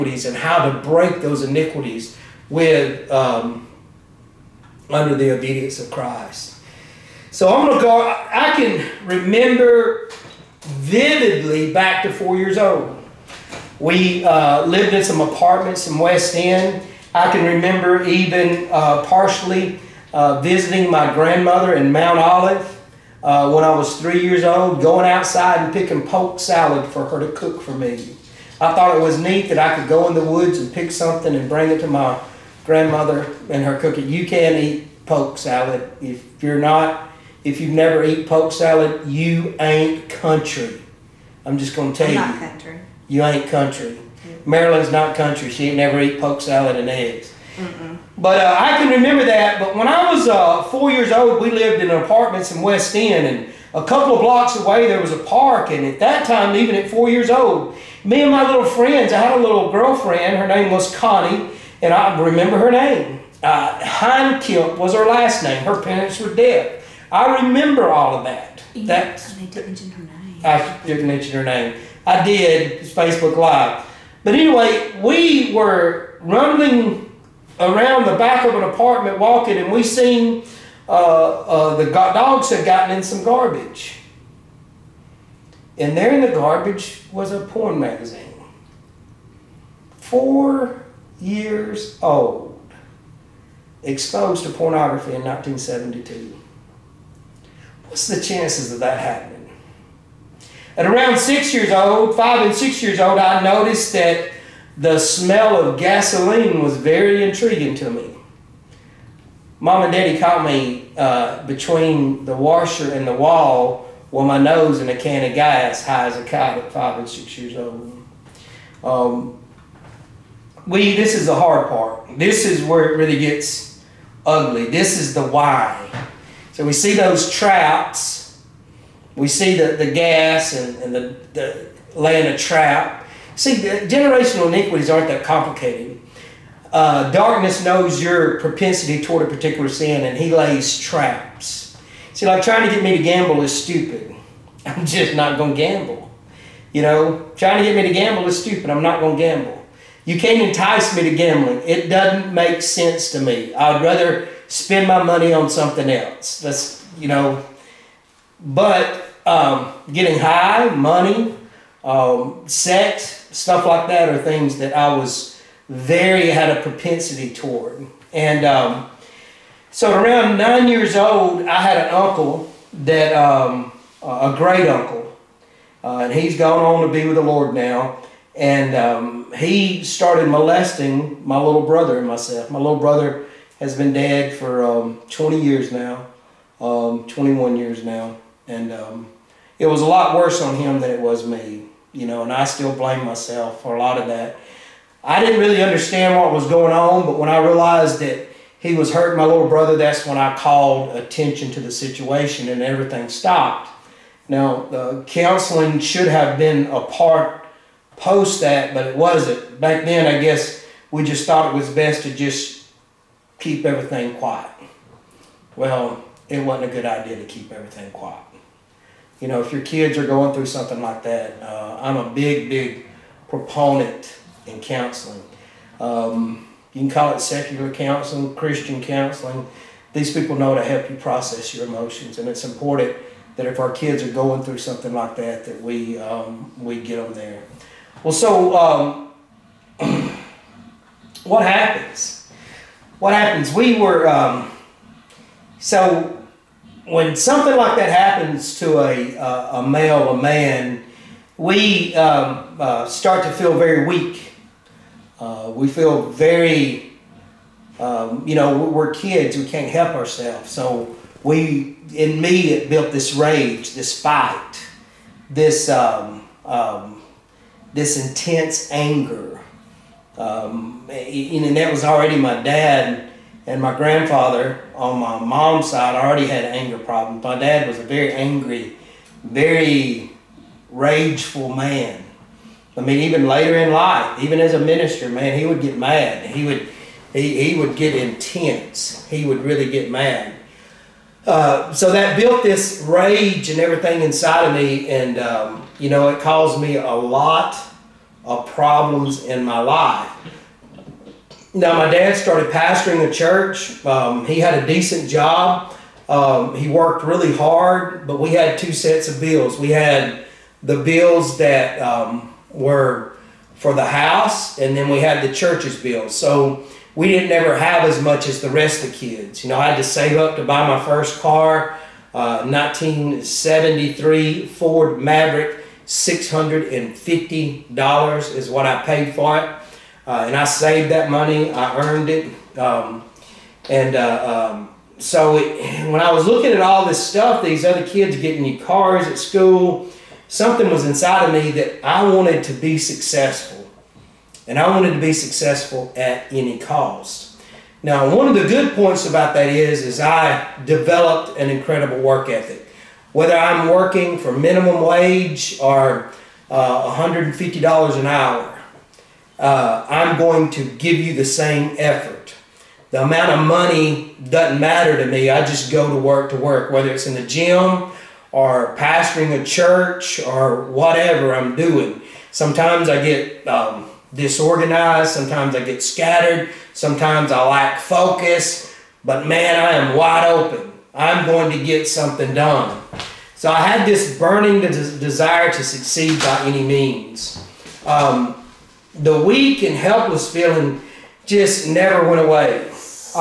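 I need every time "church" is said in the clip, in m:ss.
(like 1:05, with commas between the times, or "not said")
5:03, 5:15, 6:09.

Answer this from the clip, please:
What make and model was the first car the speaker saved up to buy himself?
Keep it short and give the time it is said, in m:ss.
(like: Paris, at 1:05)
Ford Maverick, at 5:24.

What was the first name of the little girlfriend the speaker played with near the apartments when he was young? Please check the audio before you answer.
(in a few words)
Connie.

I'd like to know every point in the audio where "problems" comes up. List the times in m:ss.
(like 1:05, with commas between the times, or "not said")
4:36, 4:58.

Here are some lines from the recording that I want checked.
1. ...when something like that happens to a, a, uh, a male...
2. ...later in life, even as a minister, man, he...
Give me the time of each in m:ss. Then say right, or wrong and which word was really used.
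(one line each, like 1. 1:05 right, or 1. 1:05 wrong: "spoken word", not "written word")
1. 4:06 right
2. 4:43 right.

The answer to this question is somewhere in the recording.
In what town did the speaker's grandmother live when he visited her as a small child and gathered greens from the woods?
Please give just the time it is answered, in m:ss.
0:21.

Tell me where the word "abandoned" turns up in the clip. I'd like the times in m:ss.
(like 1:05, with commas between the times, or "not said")
not said.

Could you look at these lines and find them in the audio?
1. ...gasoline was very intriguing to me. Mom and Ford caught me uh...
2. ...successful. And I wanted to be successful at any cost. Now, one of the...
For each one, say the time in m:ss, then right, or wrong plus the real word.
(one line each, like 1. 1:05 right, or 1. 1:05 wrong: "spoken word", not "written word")
1. 1:45 wrong: "Daddy", not "Ford"
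2. 5:42 right.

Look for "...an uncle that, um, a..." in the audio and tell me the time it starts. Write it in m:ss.
2:51.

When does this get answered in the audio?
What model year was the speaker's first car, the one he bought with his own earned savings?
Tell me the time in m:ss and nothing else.
5:22.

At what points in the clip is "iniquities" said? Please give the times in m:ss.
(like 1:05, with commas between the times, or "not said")
0:01, 2:14.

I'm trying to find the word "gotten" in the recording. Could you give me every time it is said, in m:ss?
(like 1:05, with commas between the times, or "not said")
1:22.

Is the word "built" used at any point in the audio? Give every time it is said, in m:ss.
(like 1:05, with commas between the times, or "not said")
4:22, 4:52.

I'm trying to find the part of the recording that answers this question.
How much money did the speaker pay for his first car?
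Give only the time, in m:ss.
5:25.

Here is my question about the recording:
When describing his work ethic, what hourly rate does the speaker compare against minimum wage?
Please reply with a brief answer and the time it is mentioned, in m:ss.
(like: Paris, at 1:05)
$150 an hour, at 5:56.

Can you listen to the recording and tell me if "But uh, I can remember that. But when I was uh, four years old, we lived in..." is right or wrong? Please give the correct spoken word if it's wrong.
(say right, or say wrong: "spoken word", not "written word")
right.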